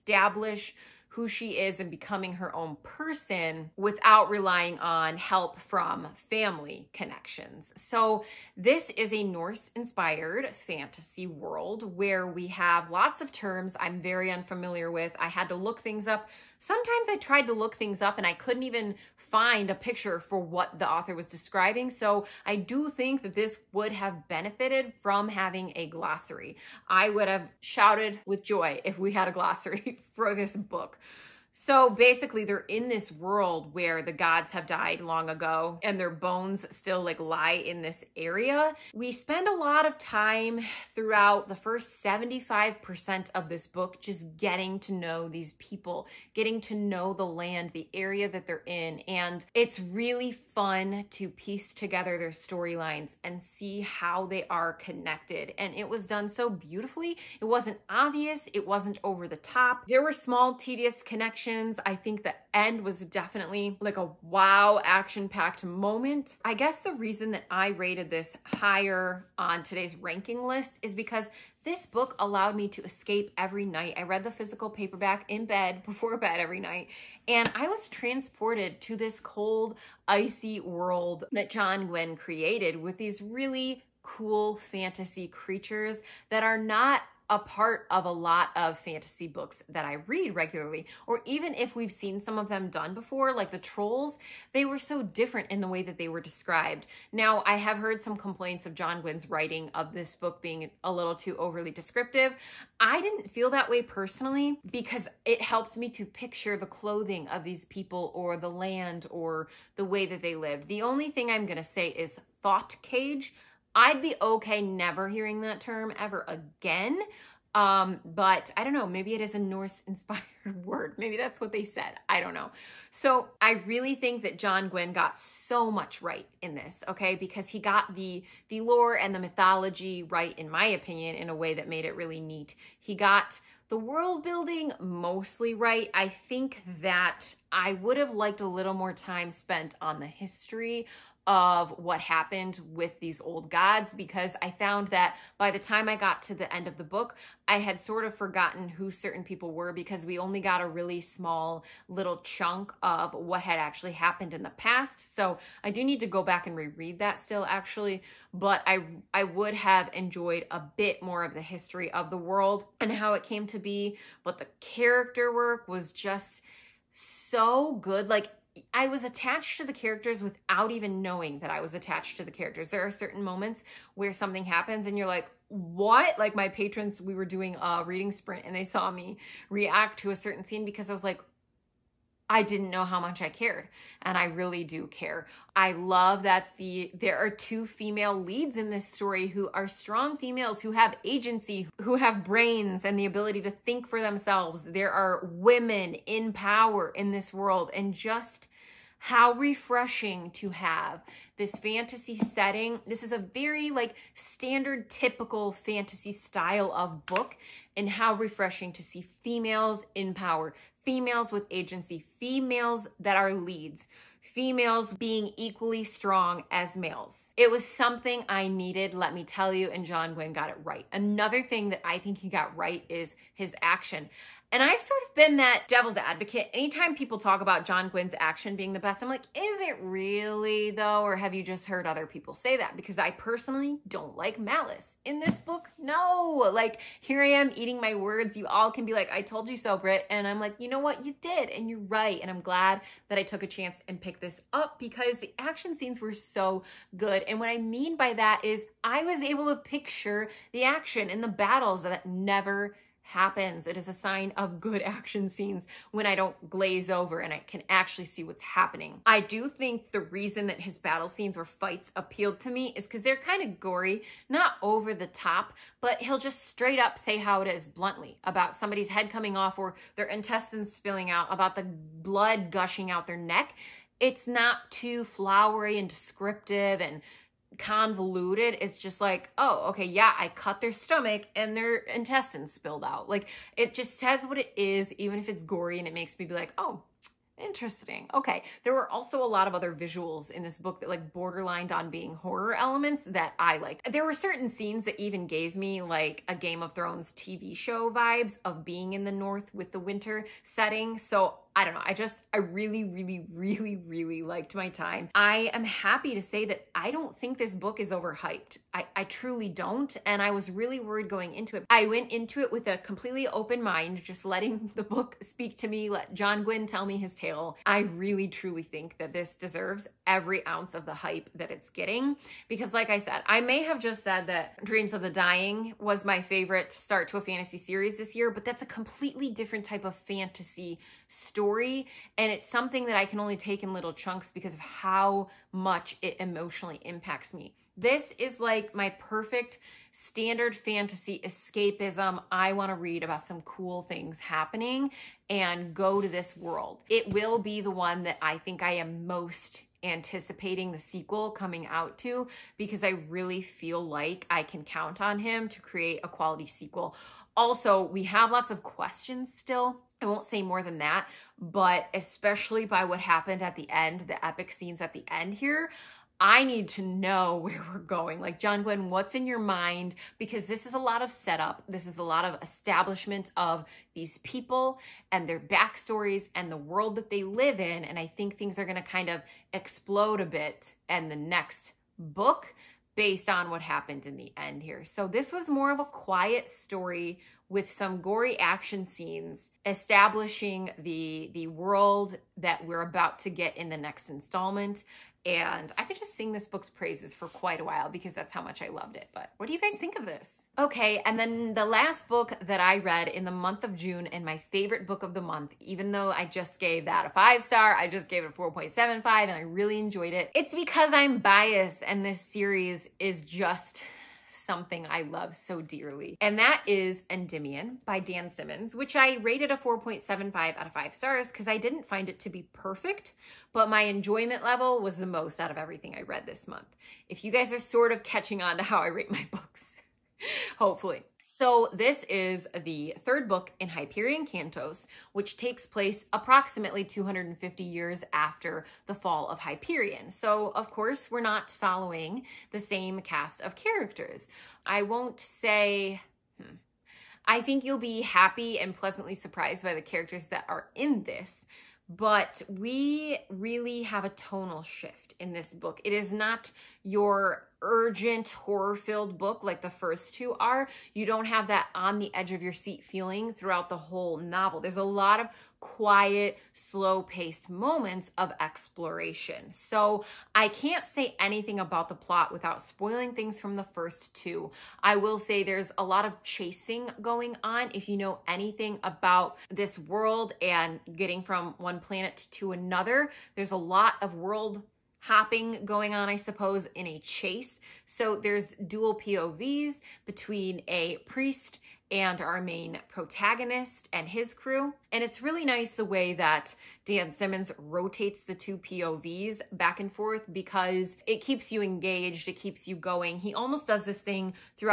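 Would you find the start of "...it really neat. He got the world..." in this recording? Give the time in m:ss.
2:11.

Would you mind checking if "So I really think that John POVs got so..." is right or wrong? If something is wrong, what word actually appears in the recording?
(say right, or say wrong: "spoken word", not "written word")
wrong: "Gwynn", not "POVs".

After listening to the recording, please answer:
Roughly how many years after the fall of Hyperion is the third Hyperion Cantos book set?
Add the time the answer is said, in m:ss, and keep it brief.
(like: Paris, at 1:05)
250, at 7:16.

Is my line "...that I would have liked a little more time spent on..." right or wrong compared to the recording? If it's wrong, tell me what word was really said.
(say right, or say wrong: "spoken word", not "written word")
right.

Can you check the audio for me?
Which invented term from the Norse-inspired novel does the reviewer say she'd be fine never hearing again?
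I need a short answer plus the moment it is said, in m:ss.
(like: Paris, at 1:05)
Thought cage, at 1:52.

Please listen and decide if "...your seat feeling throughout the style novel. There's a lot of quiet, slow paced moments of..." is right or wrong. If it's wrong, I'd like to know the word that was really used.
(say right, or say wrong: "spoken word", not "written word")
wrong: "whole", not "style".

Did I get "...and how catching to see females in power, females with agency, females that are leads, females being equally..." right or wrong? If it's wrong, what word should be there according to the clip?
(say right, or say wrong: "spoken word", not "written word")
wrong: "refreshing", not "catching".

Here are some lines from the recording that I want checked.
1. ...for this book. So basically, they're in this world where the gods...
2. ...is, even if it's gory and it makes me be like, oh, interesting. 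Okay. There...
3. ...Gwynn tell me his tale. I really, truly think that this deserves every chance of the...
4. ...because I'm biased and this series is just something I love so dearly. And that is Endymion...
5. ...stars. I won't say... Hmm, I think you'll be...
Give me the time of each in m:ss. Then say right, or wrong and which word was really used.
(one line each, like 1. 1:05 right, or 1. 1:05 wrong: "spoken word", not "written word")
1. 0:30 right
2. 4:44 right
3. 5:16 wrong: "ounce", not "chance"
4. 6:50 right
5. 7:23 wrong: "characters", not "stars".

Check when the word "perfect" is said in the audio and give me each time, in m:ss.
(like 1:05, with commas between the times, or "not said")
5:38, 7:02.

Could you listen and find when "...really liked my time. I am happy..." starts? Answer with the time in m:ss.
5:03.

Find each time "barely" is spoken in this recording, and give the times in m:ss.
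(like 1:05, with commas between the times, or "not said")
not said.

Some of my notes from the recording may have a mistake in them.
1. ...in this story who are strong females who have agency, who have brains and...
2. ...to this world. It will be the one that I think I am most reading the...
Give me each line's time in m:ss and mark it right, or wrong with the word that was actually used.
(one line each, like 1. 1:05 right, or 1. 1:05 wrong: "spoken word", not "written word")
1. 3:08 right
2. 5:46 wrong: "anticipating", not "reading".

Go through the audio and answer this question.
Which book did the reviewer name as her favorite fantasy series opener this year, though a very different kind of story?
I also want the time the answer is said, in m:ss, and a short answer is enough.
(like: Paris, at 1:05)
Dreams of the Dying, at 5:24.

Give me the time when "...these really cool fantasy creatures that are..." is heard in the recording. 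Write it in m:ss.
1:22.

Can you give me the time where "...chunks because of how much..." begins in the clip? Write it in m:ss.
5:33.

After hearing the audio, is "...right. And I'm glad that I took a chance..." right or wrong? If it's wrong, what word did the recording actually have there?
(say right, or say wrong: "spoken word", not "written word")
right.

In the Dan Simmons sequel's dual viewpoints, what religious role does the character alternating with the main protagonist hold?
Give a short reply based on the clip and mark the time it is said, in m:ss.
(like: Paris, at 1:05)
A priest, at 8:11.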